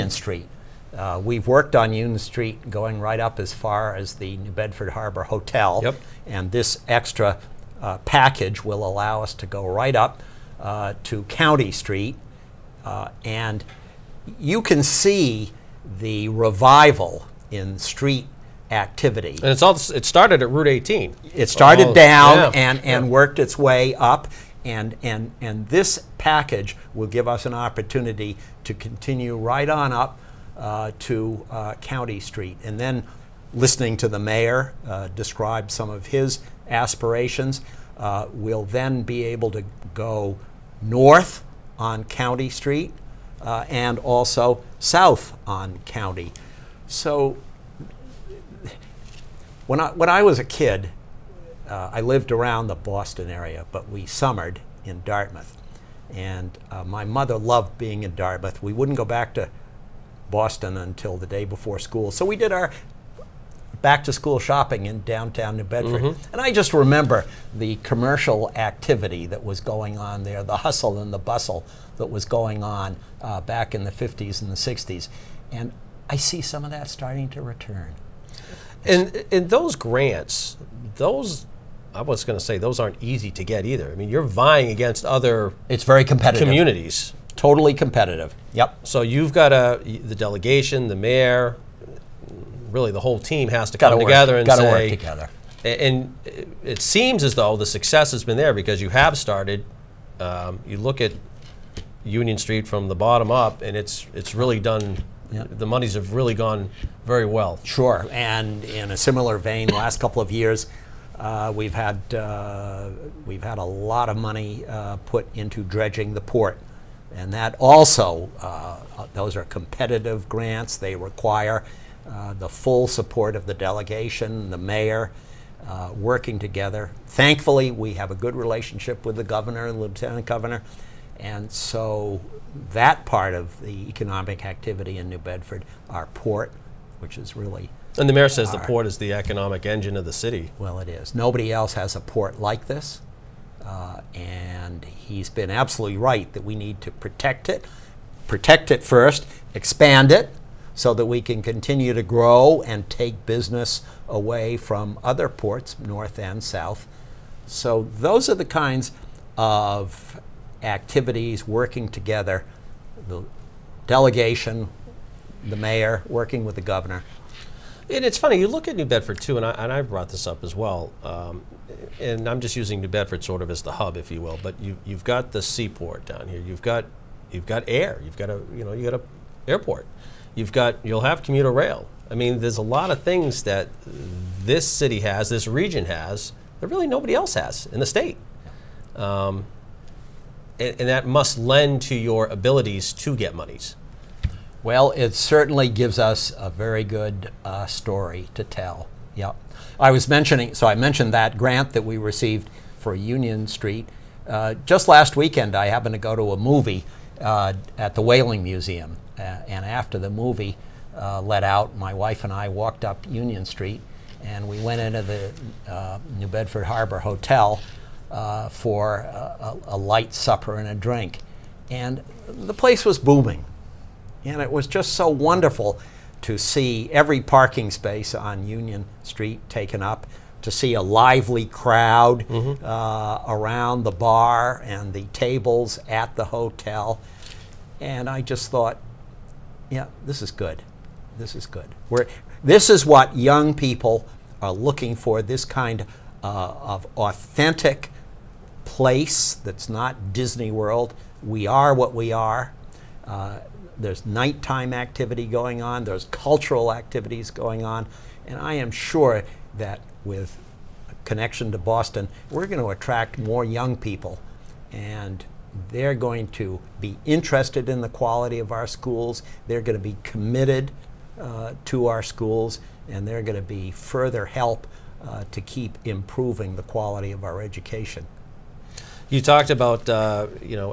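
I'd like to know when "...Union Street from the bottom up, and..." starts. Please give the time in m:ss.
1:42.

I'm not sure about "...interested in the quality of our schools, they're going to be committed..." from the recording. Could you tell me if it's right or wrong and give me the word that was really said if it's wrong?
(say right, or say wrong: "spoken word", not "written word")
right.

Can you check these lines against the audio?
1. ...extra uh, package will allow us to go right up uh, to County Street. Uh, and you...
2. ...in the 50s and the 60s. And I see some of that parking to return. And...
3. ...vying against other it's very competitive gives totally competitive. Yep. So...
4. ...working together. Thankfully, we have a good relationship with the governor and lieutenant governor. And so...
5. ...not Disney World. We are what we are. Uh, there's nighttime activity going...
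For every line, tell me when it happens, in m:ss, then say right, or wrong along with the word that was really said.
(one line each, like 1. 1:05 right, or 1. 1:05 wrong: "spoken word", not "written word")
1. 0:06 right
2. 1:13 wrong: "starting", not "parking"
3. 1:24 wrong: "communities", not "gives"
4. 2:05 right
5. 4:09 right.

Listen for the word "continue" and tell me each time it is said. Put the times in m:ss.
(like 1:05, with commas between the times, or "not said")
0:28, 2:31.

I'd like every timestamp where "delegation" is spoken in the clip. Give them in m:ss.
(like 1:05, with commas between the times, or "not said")
1:30, 2:03, 2:43.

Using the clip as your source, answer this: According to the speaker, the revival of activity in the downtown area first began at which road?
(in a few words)
Route 18.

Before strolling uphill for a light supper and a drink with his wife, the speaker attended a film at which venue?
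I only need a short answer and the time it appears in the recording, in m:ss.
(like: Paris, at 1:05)
Whaling Museum, at 3:28.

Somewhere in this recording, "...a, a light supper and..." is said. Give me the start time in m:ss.
3:38.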